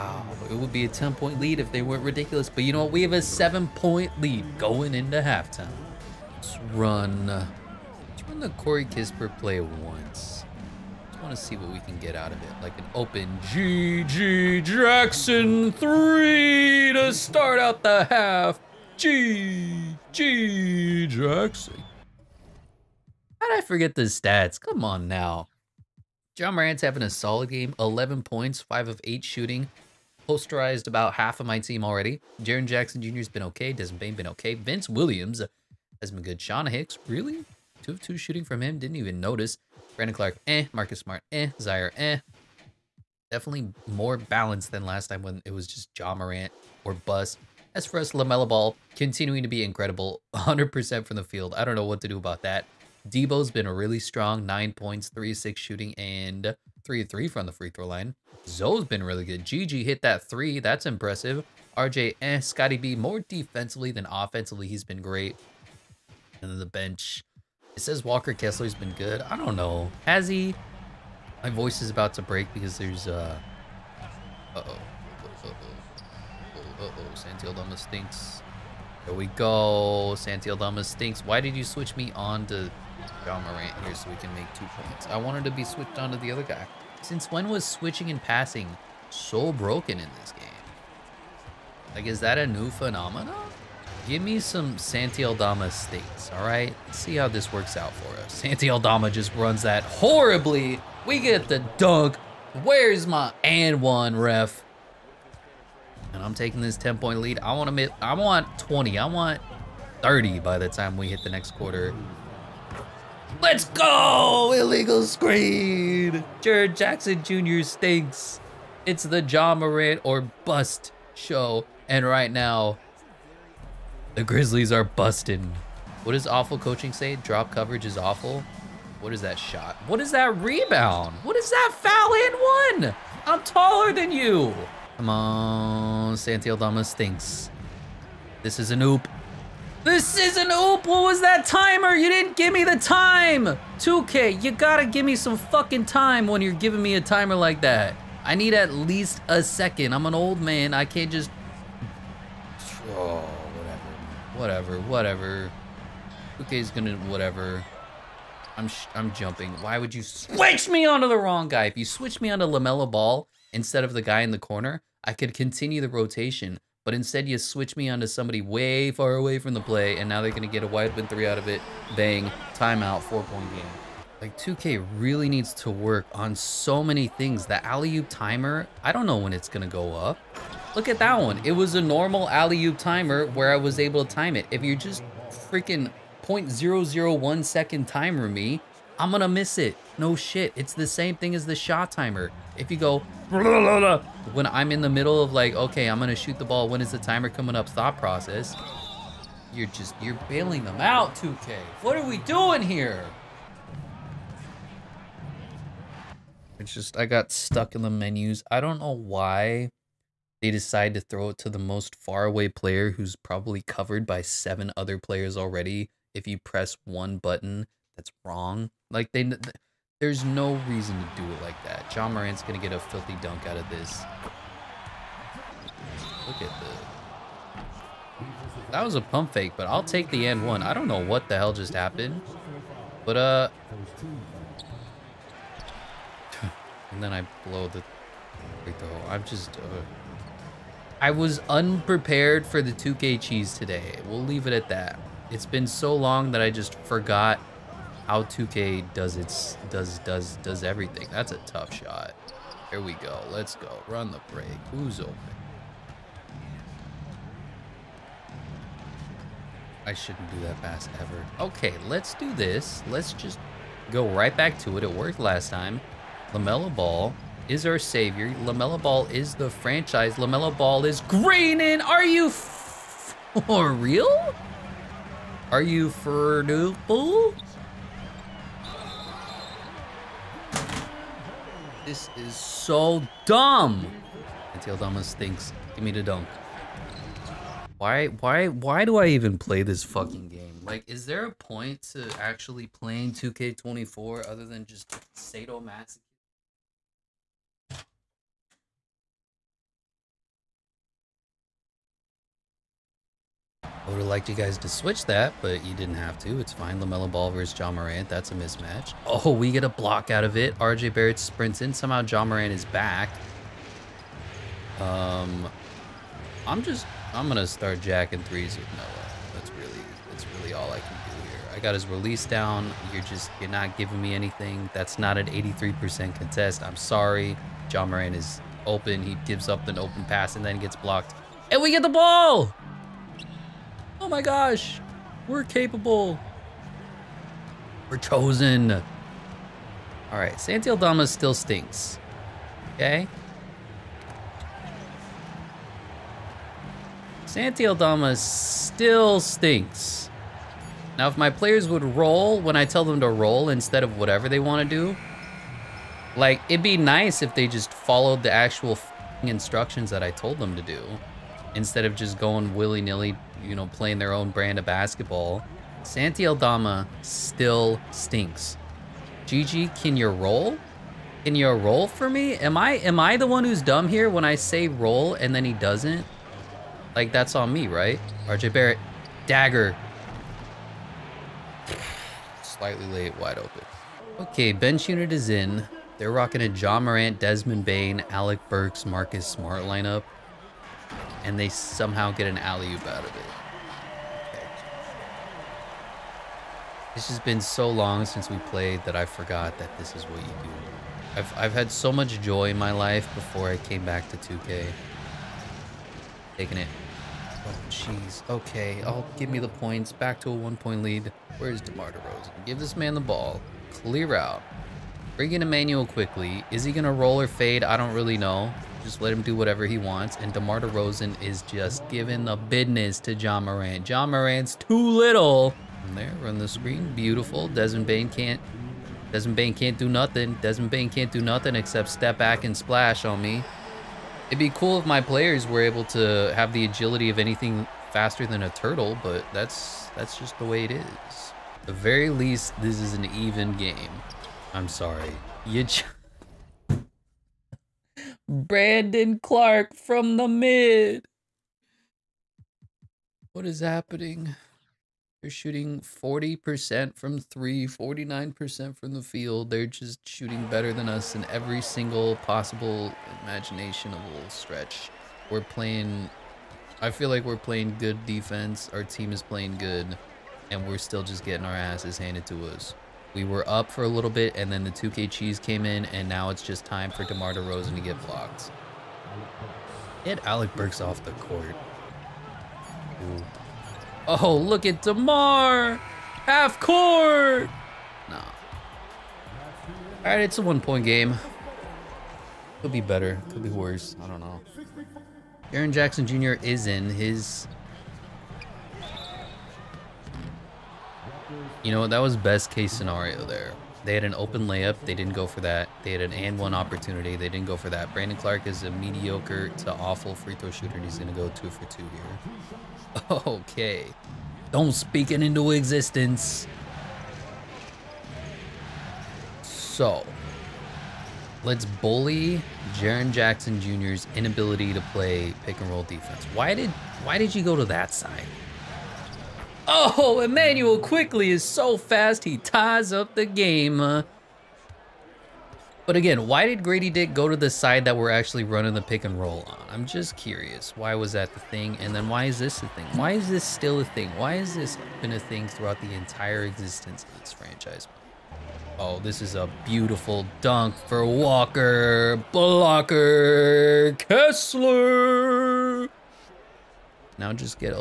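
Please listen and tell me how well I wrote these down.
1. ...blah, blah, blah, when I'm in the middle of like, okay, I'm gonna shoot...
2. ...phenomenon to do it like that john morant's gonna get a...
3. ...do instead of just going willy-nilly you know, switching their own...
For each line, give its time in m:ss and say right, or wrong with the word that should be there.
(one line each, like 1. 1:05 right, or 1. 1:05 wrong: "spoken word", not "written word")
1. 3:13 right
2. 3:40 wrong: "reason", not "phenomenon"
3. 6:00 wrong: "playing", not "switching".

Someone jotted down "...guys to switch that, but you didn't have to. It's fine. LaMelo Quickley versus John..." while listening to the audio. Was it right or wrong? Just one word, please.
wrong.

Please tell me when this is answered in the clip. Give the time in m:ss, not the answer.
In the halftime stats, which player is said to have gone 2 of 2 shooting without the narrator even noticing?
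0:36.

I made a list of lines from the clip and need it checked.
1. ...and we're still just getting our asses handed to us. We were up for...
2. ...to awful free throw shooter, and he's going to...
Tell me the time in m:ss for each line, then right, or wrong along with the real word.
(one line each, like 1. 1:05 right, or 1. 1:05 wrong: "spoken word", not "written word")
1. 7:50 right
2. 8:29 right.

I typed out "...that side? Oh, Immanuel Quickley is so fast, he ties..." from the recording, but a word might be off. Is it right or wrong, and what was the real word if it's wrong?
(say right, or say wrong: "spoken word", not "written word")
right.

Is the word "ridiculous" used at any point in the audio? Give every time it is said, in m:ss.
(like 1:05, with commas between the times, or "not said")
0:02.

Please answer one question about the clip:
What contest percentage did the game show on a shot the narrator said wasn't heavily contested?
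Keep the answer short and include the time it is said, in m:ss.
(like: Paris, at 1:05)
83%, at 5:25.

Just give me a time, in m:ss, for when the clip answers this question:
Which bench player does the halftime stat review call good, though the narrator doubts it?
1:08.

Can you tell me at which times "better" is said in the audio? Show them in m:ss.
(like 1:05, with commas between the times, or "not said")
7:40, 8:12.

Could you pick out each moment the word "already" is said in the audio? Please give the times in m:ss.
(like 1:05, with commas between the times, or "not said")
0:31, 3:35.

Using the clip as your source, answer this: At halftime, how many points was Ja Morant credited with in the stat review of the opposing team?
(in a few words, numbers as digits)
11.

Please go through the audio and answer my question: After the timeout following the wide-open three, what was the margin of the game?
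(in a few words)
4.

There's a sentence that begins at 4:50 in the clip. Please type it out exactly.
Like, is there a point to actually playing 2K24 other than just sadomasochism?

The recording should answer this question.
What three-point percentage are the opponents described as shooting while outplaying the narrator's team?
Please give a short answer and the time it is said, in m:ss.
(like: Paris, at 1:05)
40%, at 7:35.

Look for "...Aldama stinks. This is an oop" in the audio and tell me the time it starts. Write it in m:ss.
2:16.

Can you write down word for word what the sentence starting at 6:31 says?
And they somehow get an alley-oop out of it.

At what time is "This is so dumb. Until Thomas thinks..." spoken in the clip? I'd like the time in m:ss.
4:41.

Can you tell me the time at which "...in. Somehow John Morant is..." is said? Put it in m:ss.
5:11.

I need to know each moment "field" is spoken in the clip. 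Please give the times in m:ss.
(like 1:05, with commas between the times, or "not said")
0:51, 7:39.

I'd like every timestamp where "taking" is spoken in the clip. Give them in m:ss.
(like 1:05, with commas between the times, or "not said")
1:46, 6:46.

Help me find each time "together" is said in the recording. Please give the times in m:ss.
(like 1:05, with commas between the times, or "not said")
not said.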